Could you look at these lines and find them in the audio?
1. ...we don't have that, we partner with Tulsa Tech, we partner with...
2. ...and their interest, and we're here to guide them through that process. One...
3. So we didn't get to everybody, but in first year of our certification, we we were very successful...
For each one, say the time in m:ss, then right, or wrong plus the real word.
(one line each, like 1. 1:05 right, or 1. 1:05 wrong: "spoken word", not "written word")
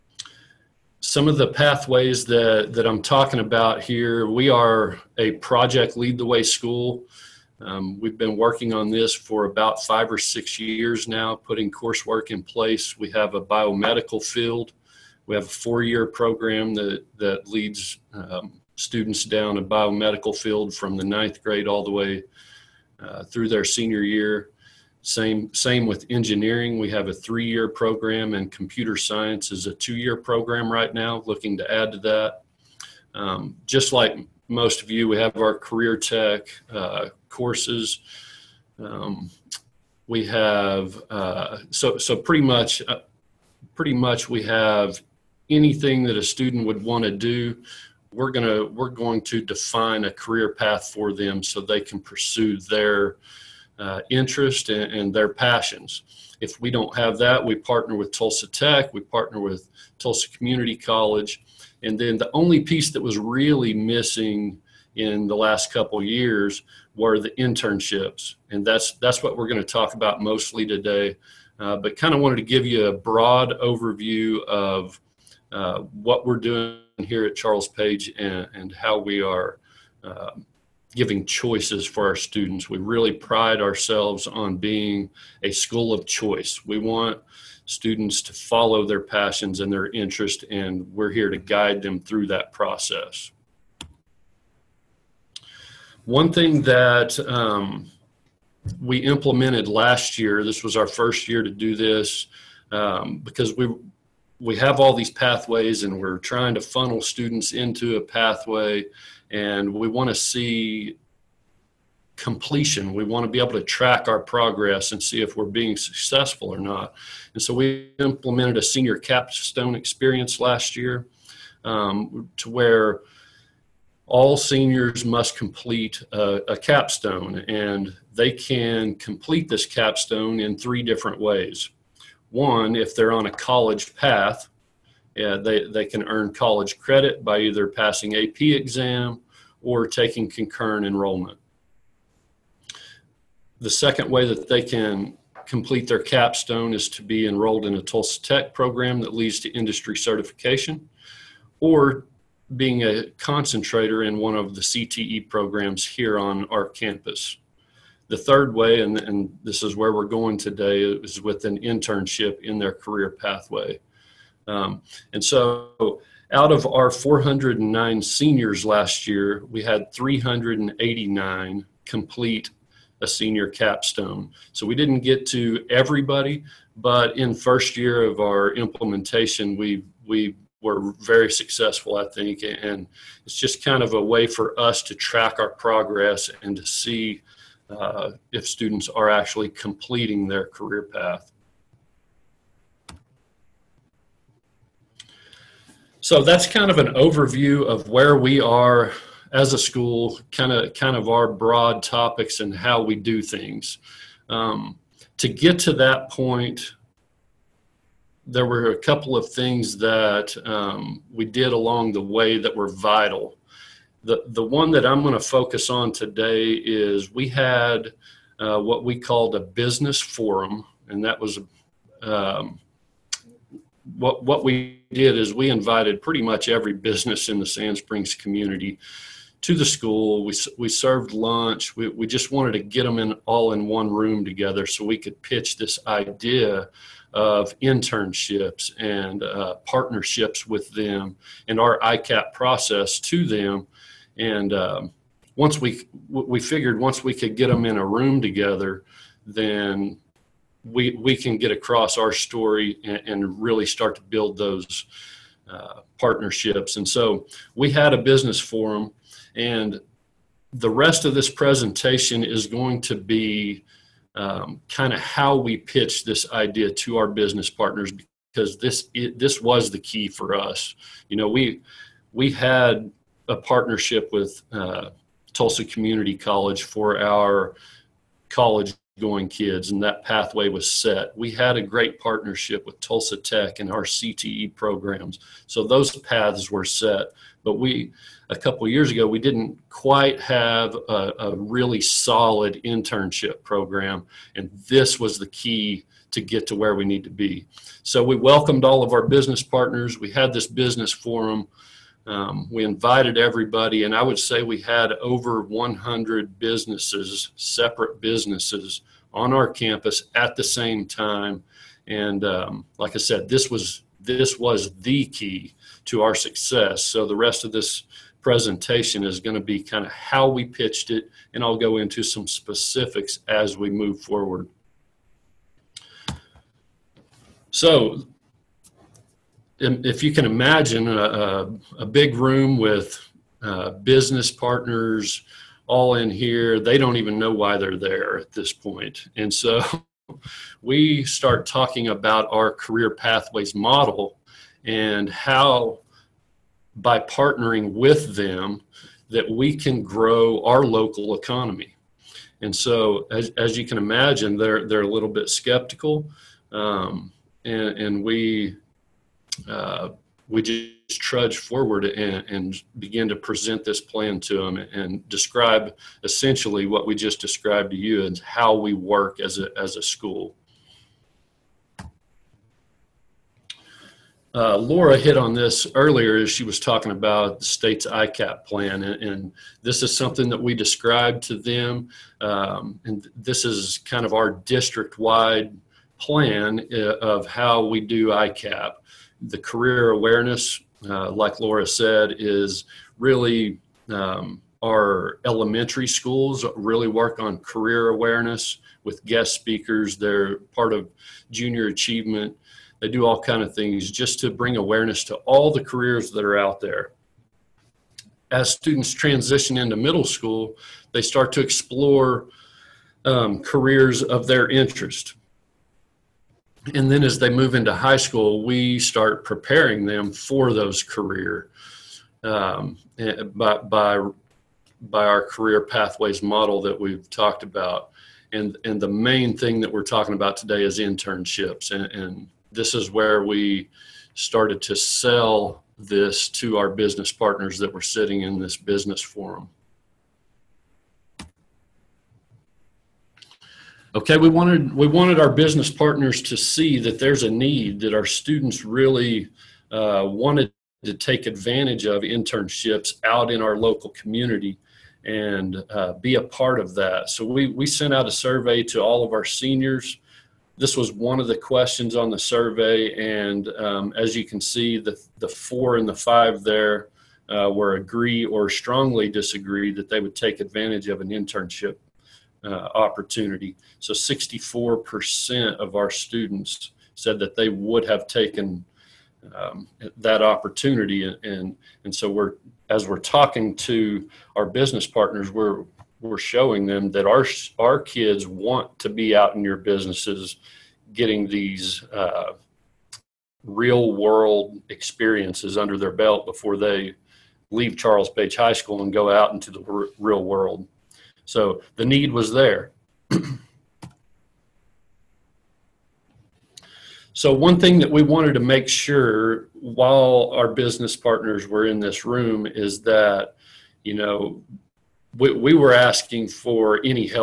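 1. 0:56 right
2. 1:29 right
3. 2:54 wrong: "implementation", not "certification".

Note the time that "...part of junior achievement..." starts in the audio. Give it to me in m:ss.
6:40.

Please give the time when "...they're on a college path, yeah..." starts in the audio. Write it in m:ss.
2:12.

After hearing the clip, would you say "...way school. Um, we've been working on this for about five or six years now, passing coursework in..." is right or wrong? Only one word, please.
wrong.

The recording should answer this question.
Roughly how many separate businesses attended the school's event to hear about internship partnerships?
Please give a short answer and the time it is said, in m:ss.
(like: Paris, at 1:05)
over 100, at 5:04.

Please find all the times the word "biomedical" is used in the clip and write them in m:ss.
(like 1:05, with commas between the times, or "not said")
0:13, 0:19.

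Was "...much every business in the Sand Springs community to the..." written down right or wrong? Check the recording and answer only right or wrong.
right.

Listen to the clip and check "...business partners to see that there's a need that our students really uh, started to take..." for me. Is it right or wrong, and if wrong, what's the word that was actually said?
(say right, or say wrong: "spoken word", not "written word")
wrong: "wanted", not "started".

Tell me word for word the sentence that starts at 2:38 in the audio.
The third way, and, and this is where we're going today, is with an internship in their career pathway.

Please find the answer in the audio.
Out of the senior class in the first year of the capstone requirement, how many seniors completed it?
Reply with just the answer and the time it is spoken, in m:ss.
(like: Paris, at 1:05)
389, at 2:49.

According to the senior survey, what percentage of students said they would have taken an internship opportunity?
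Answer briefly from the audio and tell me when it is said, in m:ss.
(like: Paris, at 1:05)
64%, at 7:53.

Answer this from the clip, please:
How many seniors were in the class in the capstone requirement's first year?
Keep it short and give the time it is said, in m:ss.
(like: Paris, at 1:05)
409, at 2:46.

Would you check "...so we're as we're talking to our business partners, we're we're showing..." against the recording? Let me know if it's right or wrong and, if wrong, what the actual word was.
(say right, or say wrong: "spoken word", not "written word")
right.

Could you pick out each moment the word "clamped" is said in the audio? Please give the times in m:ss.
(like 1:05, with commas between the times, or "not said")
not said.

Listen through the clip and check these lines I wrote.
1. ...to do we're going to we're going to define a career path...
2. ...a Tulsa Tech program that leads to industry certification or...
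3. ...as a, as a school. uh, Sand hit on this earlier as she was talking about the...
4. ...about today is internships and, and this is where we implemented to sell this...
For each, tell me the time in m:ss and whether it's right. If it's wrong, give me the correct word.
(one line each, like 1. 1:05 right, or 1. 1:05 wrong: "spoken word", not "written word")
1. 0:47 right
2. 2:27 right
3. 6:09 wrong: "Laura", not "Sand"
4. 7:10 wrong: "started", not "implemented".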